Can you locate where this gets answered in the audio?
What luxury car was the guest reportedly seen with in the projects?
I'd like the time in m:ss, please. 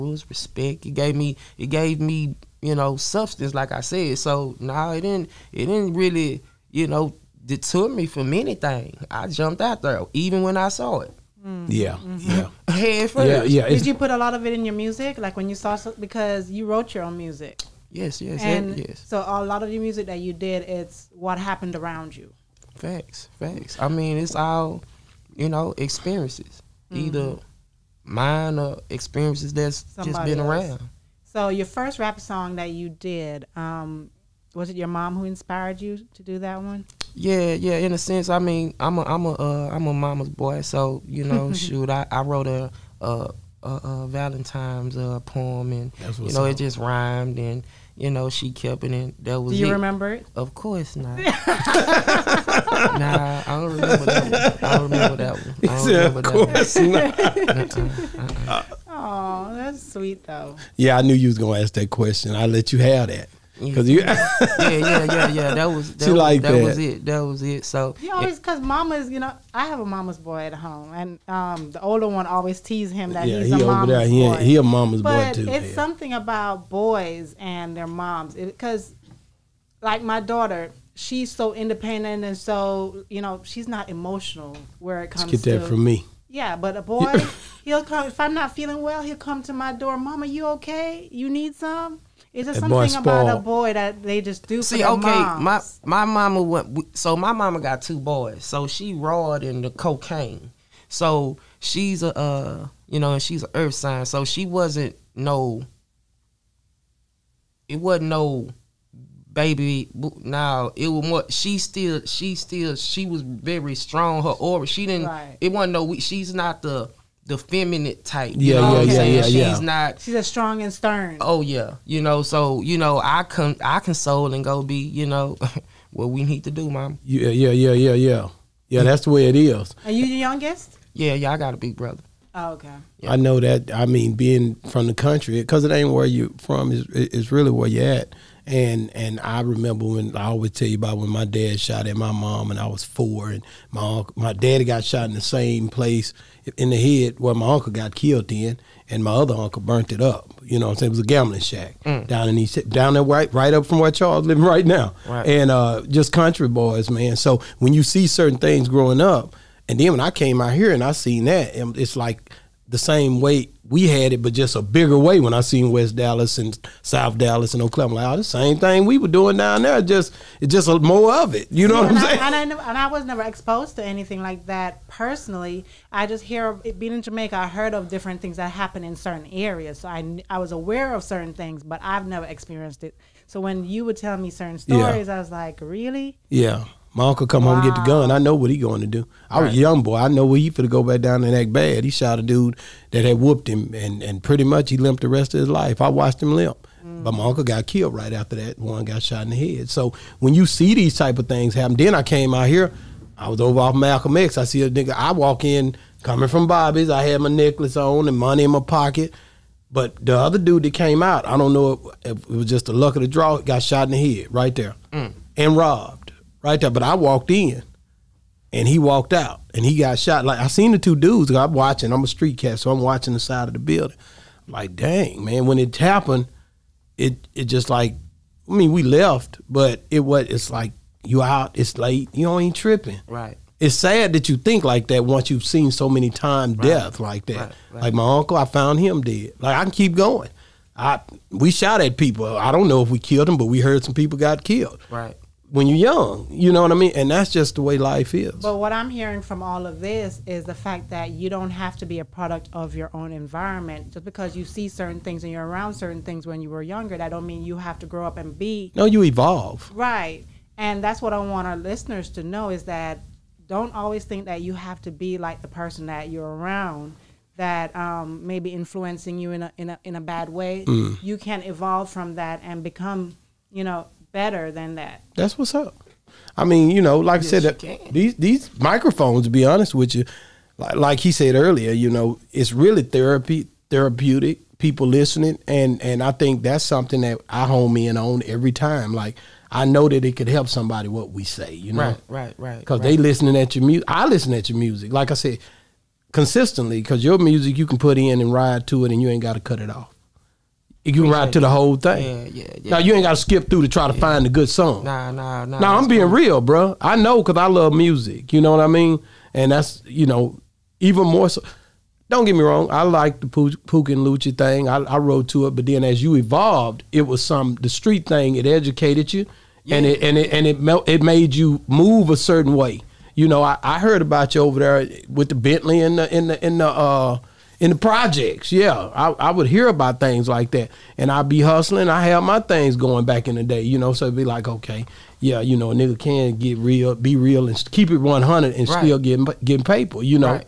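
5:25.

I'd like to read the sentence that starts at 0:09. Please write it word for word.
I jumped out there even when I saw it.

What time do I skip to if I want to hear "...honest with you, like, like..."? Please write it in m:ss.
4:39.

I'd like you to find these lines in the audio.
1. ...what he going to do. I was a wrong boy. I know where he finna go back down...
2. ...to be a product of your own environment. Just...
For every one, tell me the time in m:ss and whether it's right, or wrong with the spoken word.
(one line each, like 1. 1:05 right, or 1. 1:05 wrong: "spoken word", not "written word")
1. 3:08 wrong: "young", not "wrong"
2. 4:11 right.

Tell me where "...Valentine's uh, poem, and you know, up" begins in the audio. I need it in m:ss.
0:44.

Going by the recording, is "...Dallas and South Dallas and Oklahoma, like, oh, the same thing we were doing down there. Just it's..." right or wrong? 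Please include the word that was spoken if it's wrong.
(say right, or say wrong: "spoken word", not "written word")
right.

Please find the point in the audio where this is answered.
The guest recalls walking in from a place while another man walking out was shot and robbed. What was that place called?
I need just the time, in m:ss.
3:26.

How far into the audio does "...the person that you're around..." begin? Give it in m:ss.
4:25.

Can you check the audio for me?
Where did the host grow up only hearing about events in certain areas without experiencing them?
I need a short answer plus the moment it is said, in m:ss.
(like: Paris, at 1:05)
Jamaica, at 2:57.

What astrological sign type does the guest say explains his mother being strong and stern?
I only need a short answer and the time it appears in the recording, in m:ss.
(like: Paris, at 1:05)
Earth sign, at 1:43.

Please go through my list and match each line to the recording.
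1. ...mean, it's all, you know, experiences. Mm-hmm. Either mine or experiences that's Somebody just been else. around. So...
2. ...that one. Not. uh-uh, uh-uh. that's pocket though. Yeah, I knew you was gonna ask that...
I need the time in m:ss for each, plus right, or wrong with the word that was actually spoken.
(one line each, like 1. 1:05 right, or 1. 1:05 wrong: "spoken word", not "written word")
1. 0:23 right
2. 0:57 wrong: "sweet", not "pocket".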